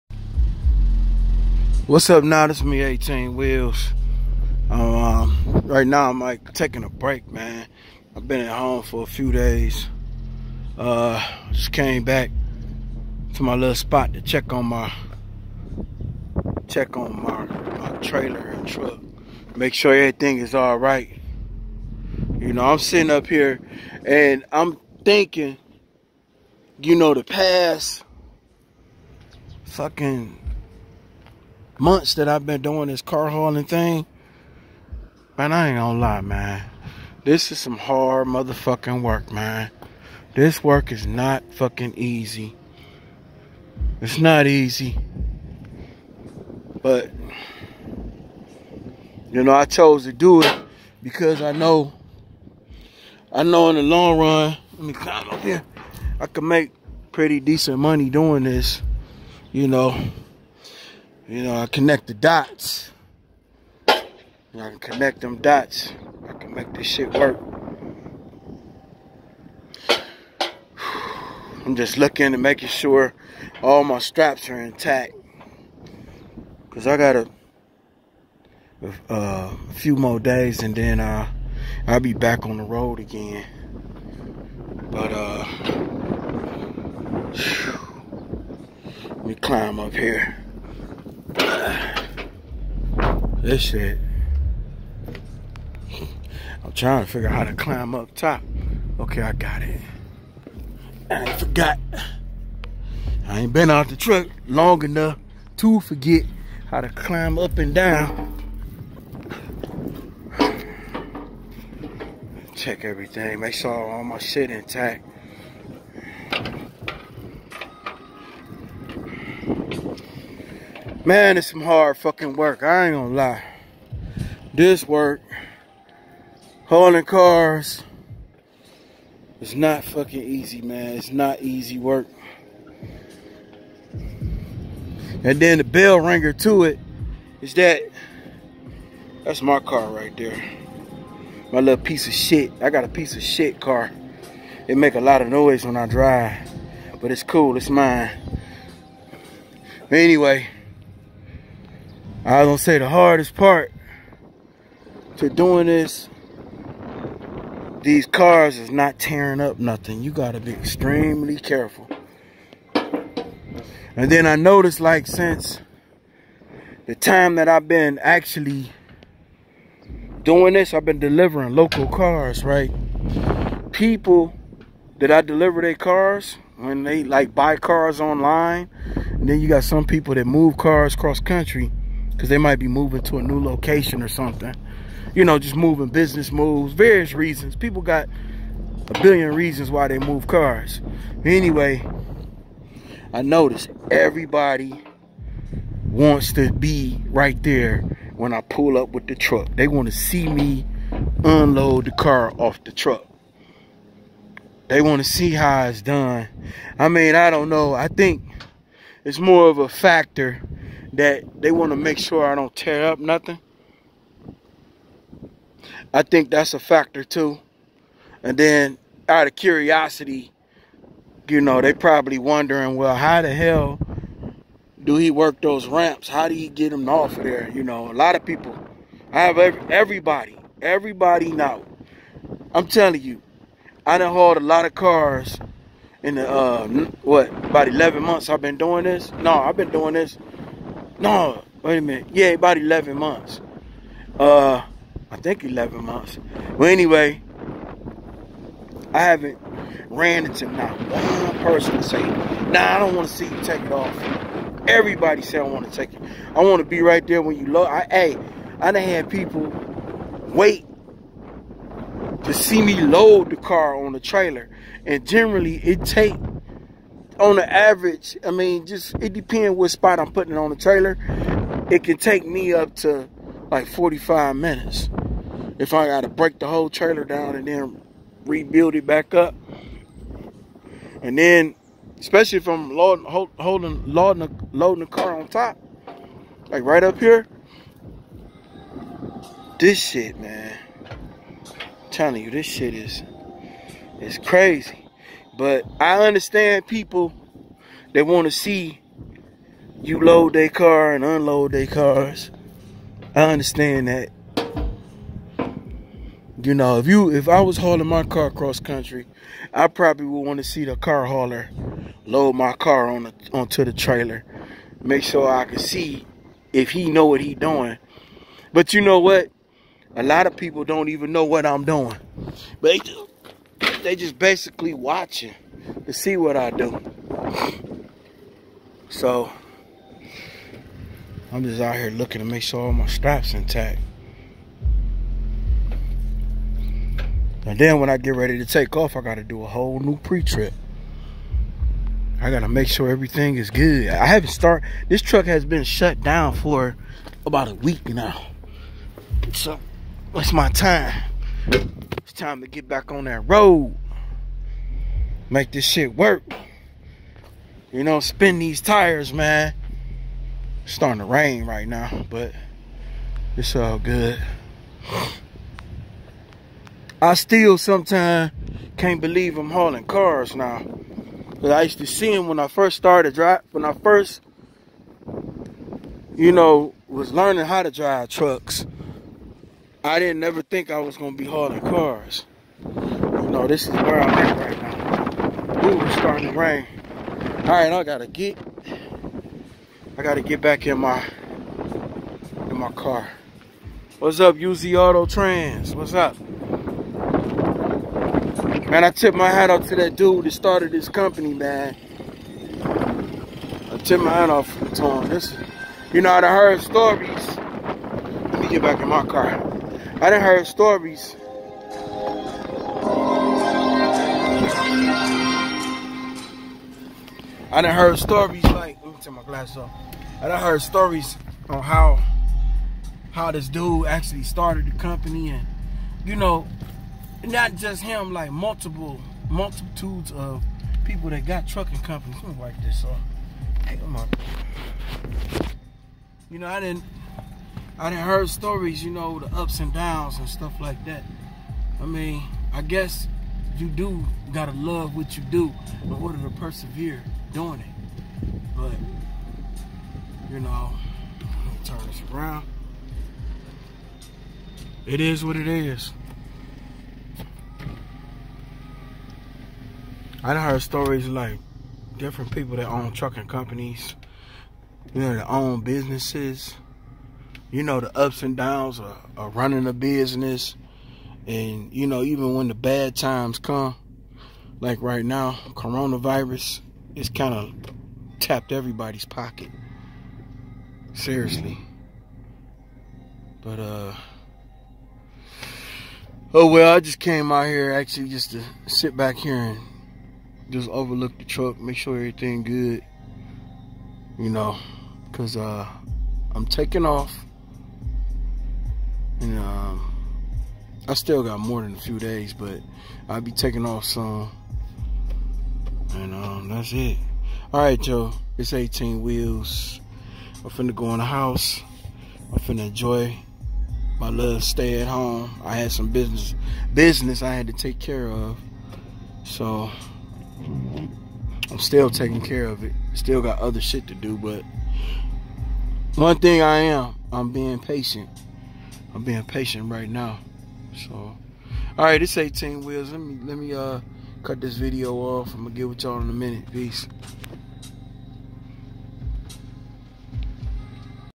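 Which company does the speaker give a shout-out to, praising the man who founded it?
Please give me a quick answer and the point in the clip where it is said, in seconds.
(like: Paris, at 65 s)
UZ Auto Trans, at 394 s.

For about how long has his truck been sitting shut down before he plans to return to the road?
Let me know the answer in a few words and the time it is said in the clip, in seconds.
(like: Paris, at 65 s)
a week, at 347 s.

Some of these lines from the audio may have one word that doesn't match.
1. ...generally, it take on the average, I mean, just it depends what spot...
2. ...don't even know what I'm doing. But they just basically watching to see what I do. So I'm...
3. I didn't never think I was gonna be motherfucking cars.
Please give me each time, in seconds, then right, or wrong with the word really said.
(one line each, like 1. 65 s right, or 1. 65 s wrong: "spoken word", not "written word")
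1. 265 s right
2. 320 s right
3. 379 s wrong: "hauling", not "motherfucking".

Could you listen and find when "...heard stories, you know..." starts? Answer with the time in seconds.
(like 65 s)
438 s.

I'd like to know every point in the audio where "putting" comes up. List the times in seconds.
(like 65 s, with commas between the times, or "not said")
270 s.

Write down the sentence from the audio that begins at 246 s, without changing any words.
Well, anyway, I haven't ran into not one person say, nah, I don't want to see you take it off.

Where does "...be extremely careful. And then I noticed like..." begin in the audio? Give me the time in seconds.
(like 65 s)
160 s.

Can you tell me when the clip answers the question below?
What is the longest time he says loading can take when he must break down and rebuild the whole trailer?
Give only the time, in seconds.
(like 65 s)
273 s.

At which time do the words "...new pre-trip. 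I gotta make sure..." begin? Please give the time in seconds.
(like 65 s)
339 s.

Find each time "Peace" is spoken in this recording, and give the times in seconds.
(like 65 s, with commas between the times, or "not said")
536 s.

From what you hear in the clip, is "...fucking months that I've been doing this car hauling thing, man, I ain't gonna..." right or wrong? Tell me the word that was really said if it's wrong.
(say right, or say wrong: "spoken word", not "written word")
right.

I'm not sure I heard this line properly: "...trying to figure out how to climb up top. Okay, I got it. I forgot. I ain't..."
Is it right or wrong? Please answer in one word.
right.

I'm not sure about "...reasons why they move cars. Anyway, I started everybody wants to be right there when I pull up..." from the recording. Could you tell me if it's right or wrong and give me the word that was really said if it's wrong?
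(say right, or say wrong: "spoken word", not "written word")
wrong: "noticed", not "started".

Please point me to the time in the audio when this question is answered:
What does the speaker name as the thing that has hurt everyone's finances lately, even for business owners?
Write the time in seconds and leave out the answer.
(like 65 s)
475 s.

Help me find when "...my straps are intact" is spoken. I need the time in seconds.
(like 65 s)
73 s.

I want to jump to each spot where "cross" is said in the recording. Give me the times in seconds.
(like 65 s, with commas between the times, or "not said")
180 s, 308 s.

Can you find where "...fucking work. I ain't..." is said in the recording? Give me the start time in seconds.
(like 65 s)
121 s.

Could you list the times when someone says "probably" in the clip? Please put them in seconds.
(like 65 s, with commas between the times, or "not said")
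221 s, 309 s.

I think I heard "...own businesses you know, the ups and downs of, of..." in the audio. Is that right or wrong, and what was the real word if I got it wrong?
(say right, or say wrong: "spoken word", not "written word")
right.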